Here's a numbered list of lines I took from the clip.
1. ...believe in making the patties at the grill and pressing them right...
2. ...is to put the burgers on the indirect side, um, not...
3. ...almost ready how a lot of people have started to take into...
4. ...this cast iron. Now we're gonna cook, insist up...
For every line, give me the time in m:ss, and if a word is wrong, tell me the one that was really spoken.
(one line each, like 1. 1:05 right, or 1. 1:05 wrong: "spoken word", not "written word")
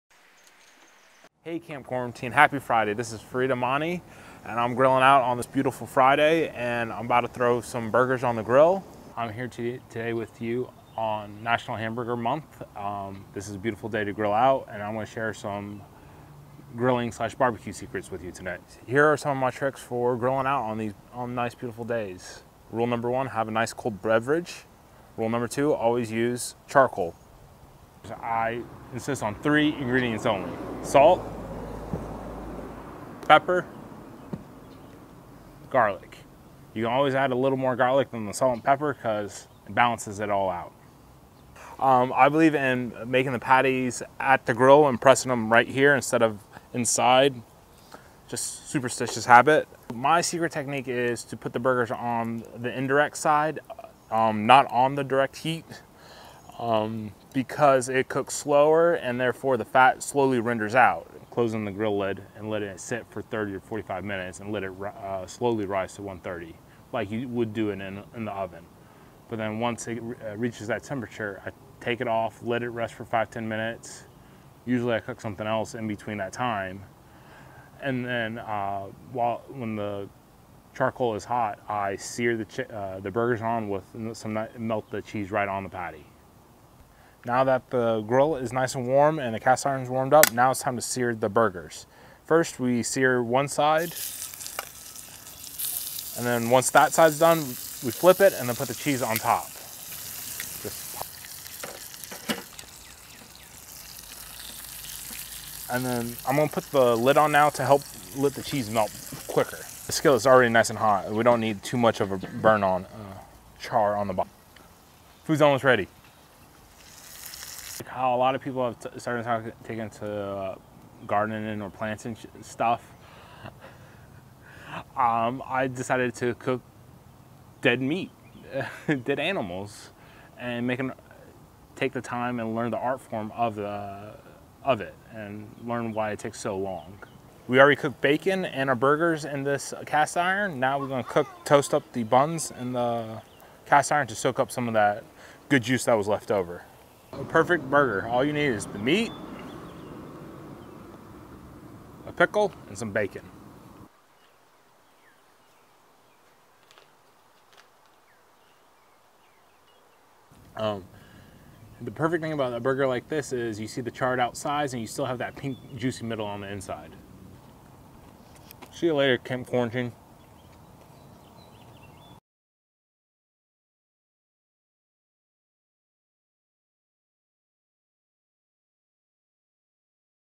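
1. 0:42 right
2. 0:50 right
3. 1:55 right
4. 2:19 wrong: "toast", not "insist".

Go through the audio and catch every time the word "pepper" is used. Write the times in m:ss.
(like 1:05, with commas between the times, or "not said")
0:33, 0:38.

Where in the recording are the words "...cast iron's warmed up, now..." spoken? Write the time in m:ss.
1:29.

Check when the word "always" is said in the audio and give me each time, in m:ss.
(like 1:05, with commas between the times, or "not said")
0:25, 0:36.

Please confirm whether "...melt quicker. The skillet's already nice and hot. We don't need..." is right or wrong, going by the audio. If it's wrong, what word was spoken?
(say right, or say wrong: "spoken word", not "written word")
right.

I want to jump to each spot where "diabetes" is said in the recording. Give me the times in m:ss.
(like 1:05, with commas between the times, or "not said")
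not said.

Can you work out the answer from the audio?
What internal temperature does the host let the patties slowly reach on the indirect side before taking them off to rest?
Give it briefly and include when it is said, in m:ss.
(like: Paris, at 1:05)
130, at 1:06.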